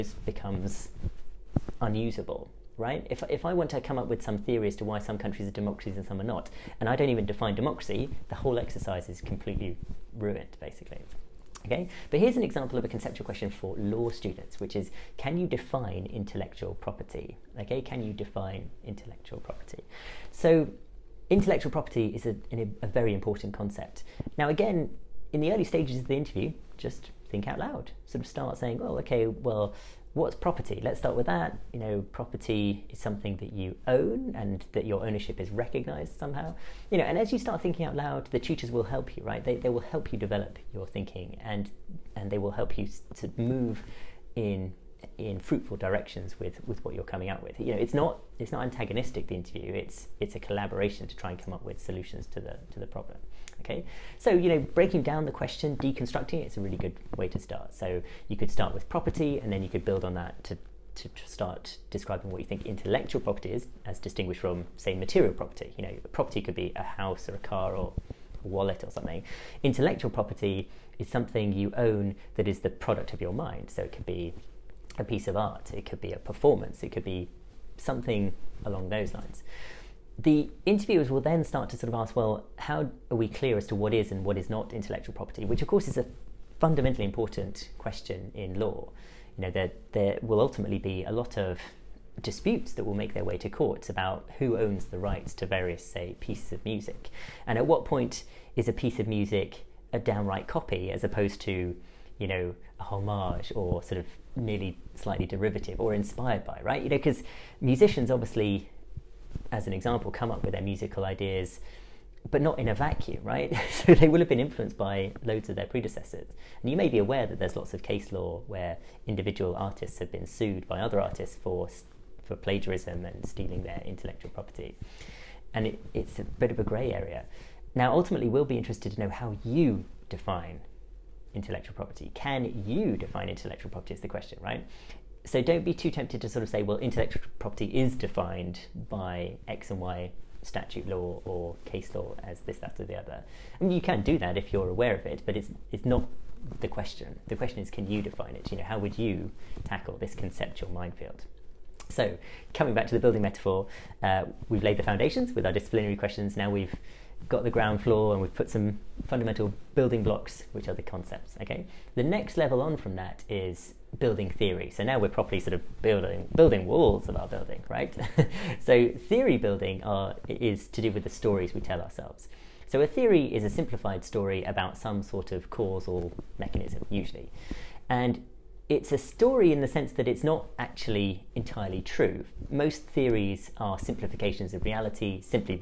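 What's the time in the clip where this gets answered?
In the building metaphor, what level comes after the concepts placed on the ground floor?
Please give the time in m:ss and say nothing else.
2:43.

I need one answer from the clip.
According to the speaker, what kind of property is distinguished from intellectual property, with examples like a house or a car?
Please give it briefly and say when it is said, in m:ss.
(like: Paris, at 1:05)
Material property, at 1:04.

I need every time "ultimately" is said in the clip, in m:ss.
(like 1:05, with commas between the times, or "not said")
1:30, 2:07.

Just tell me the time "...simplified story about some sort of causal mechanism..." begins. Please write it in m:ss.
2:53.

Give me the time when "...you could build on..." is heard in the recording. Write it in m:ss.
0:59.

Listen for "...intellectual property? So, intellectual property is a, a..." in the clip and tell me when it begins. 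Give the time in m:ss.
0:18.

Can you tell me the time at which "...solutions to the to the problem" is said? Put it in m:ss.
0:51.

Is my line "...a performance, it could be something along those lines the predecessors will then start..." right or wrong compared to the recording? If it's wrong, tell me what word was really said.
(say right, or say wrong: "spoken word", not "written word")
wrong: "interviewers", not "predecessors".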